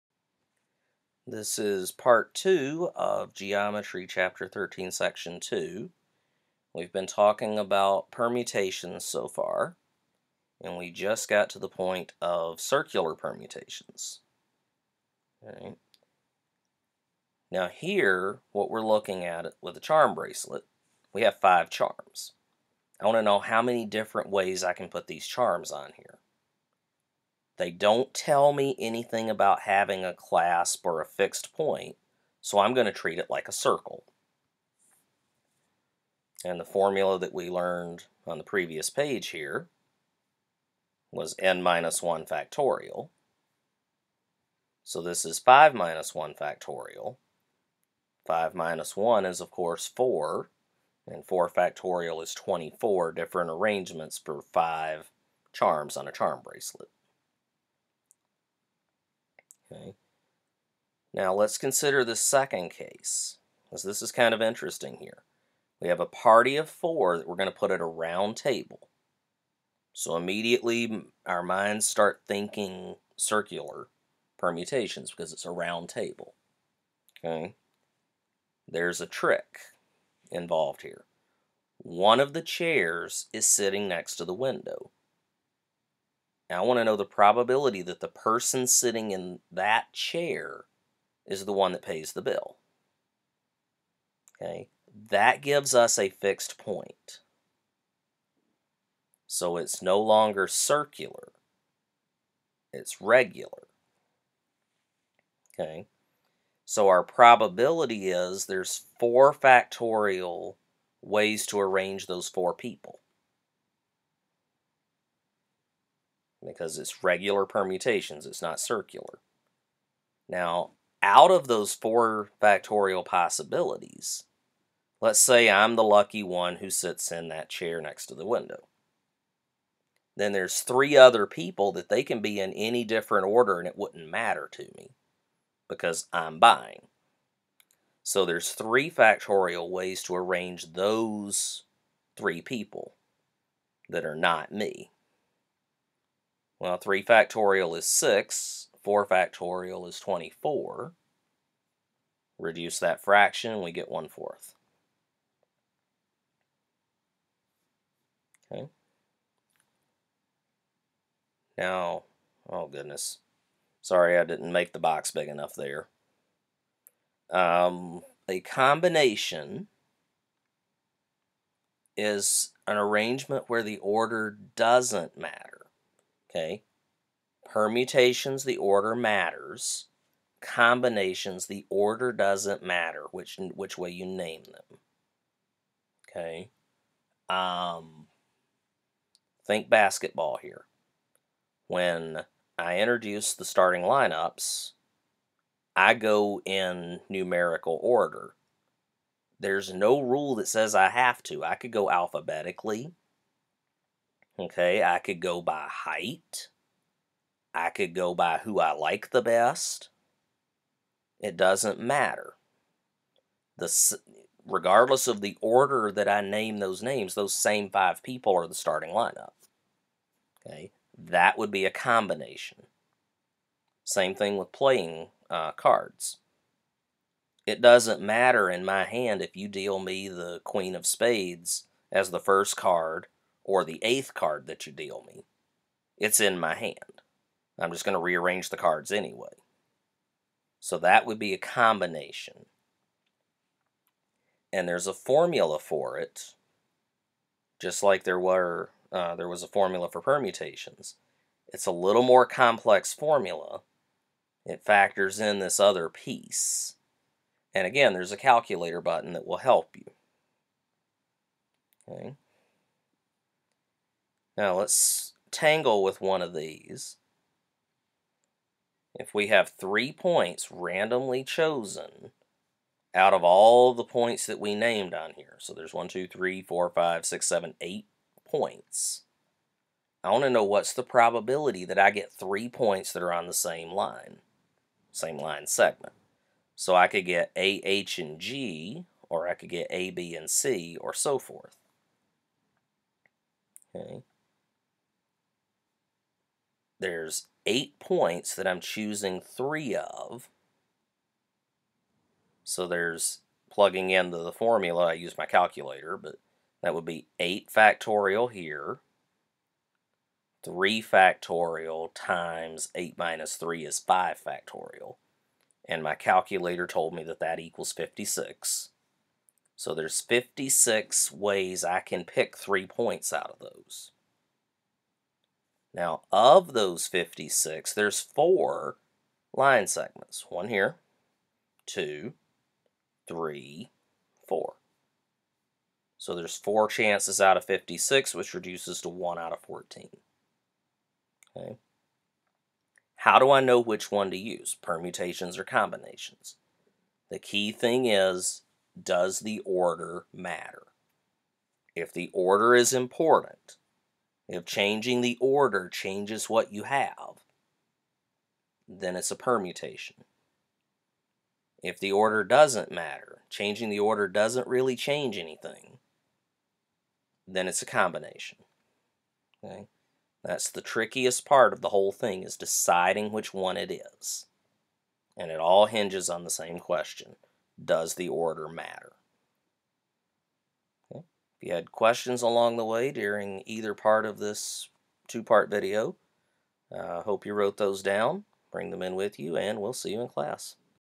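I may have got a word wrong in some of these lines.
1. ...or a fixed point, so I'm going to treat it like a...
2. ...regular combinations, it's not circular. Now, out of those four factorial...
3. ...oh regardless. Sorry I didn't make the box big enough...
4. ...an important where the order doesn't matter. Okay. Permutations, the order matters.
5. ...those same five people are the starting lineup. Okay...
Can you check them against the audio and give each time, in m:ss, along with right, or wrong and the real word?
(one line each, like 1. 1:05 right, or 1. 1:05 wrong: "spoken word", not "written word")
1. 0:30 right
2. 1:57 wrong: "permutations", not "combinations"
3. 2:42 wrong: "goodness", not "regardless"
4. 2:52 wrong: "arrangement", not "important"
5. 3:37 right.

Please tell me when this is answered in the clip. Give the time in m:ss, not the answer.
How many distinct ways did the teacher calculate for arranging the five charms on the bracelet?
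0:52.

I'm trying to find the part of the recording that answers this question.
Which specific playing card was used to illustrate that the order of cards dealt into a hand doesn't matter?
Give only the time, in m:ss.
3:50.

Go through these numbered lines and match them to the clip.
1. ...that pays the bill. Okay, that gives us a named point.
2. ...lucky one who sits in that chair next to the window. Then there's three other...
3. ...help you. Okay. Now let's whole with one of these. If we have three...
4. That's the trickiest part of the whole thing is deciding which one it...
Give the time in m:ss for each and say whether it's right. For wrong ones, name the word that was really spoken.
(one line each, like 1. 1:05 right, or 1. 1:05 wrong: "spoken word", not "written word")
1. 1:31 wrong: "fixed", not "named"
2. 2:05 right
3. 4:19 wrong: "tangle", not "whole"
4. 6:10 right.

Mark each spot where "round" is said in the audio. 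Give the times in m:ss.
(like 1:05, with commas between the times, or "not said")
1:07, 1:15.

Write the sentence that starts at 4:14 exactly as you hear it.
It factors in this other piece.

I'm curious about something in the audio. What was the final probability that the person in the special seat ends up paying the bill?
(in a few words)
1/4.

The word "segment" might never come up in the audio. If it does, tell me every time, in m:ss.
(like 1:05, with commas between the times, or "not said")
4:45, 5:29.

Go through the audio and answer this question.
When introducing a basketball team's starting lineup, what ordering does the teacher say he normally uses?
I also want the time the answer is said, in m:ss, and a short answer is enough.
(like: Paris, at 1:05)
Numerical order, at 3:17.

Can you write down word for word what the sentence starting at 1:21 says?
One of the chairs is sitting next to the window.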